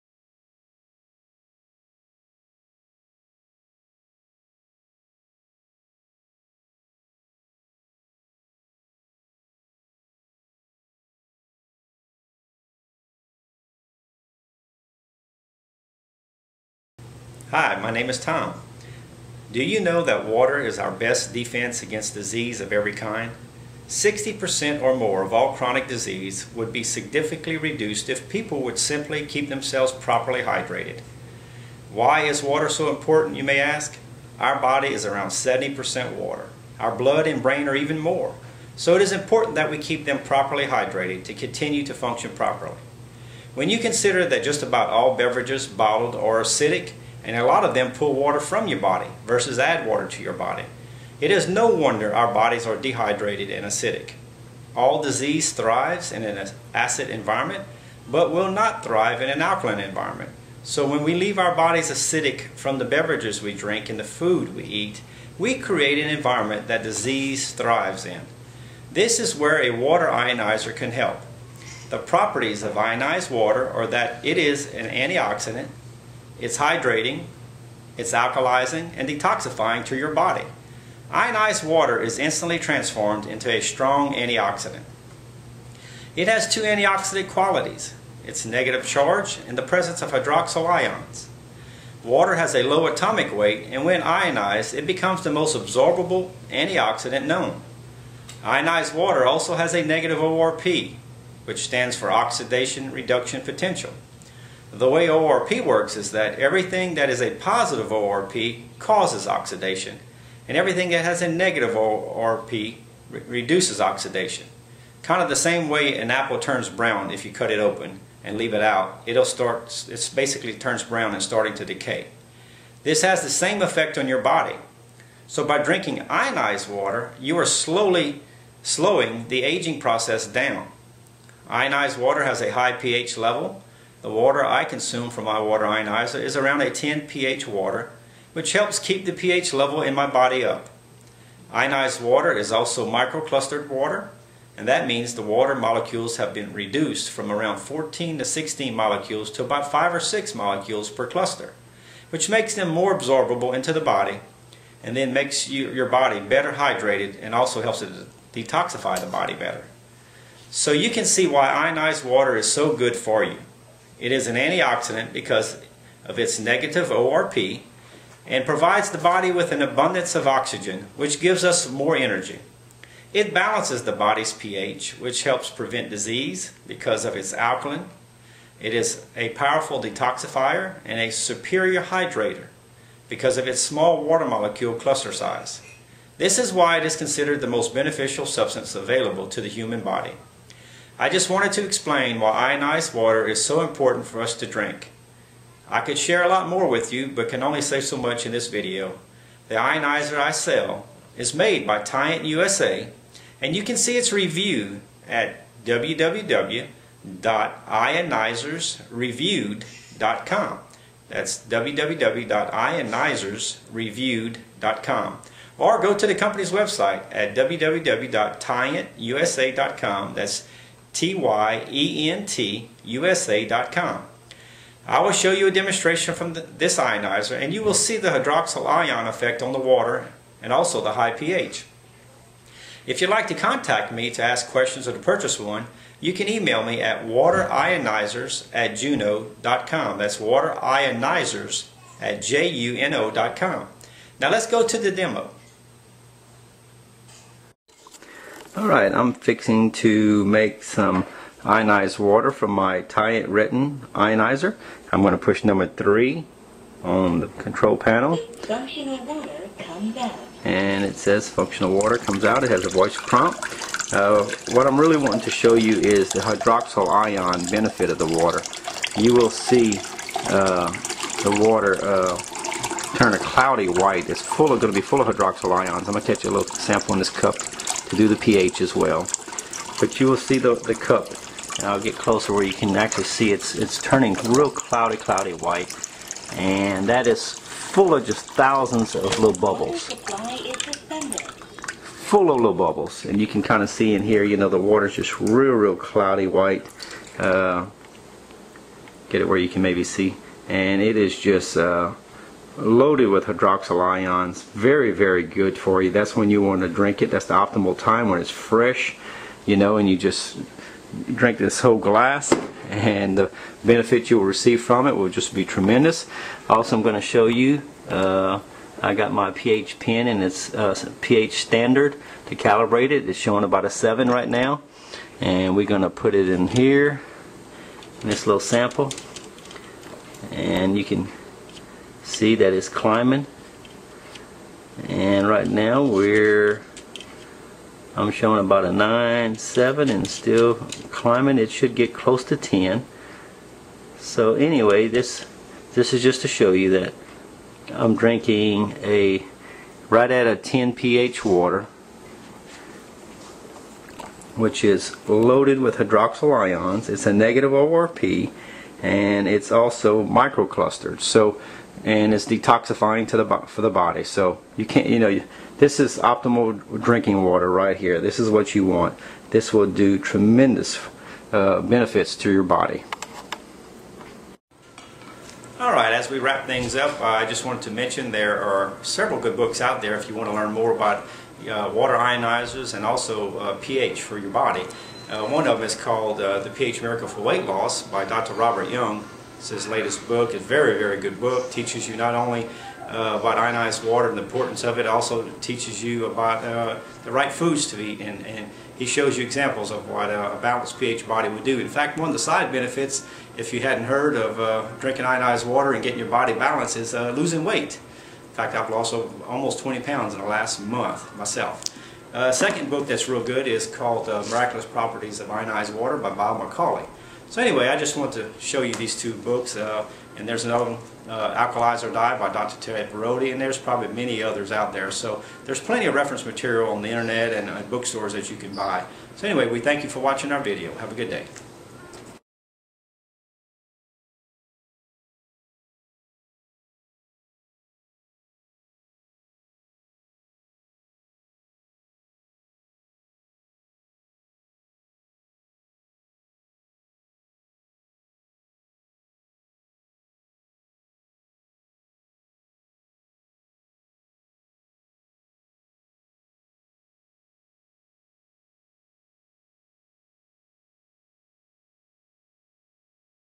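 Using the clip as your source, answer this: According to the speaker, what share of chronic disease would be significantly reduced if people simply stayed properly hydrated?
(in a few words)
60%.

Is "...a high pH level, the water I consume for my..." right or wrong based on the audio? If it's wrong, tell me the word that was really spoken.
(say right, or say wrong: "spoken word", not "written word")
right.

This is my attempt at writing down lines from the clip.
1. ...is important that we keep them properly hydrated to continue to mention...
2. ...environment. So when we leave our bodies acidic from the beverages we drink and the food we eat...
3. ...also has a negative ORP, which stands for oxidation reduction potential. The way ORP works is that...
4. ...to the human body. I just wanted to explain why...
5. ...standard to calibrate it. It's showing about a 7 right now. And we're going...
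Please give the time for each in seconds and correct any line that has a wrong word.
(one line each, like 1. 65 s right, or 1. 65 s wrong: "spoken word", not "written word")
1. 39 s wrong: "function", not "mention"
2. 59 s right
3. 99 s right
4. 189 s right
5. 321 s right.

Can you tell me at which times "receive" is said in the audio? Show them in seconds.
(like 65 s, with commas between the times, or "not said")
314 s.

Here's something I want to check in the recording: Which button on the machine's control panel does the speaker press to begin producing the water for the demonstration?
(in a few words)
3.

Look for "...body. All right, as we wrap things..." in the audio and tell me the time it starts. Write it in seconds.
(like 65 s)
372 s.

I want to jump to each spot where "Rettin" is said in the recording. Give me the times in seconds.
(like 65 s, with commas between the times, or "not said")
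253 s.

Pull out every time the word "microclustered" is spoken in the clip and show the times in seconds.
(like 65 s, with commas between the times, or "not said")
142 s, 360 s.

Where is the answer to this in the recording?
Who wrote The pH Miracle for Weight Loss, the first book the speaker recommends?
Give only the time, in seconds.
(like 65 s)
388 s.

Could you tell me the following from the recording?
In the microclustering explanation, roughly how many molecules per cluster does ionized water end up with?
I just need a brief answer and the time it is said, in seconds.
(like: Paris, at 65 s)
5 or 6, at 149 s.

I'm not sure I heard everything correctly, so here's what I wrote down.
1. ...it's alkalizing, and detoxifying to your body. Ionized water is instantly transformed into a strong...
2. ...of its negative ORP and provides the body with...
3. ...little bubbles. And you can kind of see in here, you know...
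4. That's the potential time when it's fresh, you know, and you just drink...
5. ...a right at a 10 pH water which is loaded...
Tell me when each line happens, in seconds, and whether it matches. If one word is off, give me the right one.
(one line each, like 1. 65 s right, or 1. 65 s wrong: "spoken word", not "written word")
1. 77 s right
2. 166 s right
3. 292 s right
4. 307 s wrong: "optimal", not "potential"
5. 348 s right.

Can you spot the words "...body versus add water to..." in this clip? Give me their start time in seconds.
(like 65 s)
48 s.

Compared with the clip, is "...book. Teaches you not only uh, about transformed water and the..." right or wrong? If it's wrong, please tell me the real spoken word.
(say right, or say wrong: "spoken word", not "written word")
wrong: "ionized", not "transformed".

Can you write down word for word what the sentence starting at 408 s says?
In fact, I've lost almost 20 pounds in the last month myself.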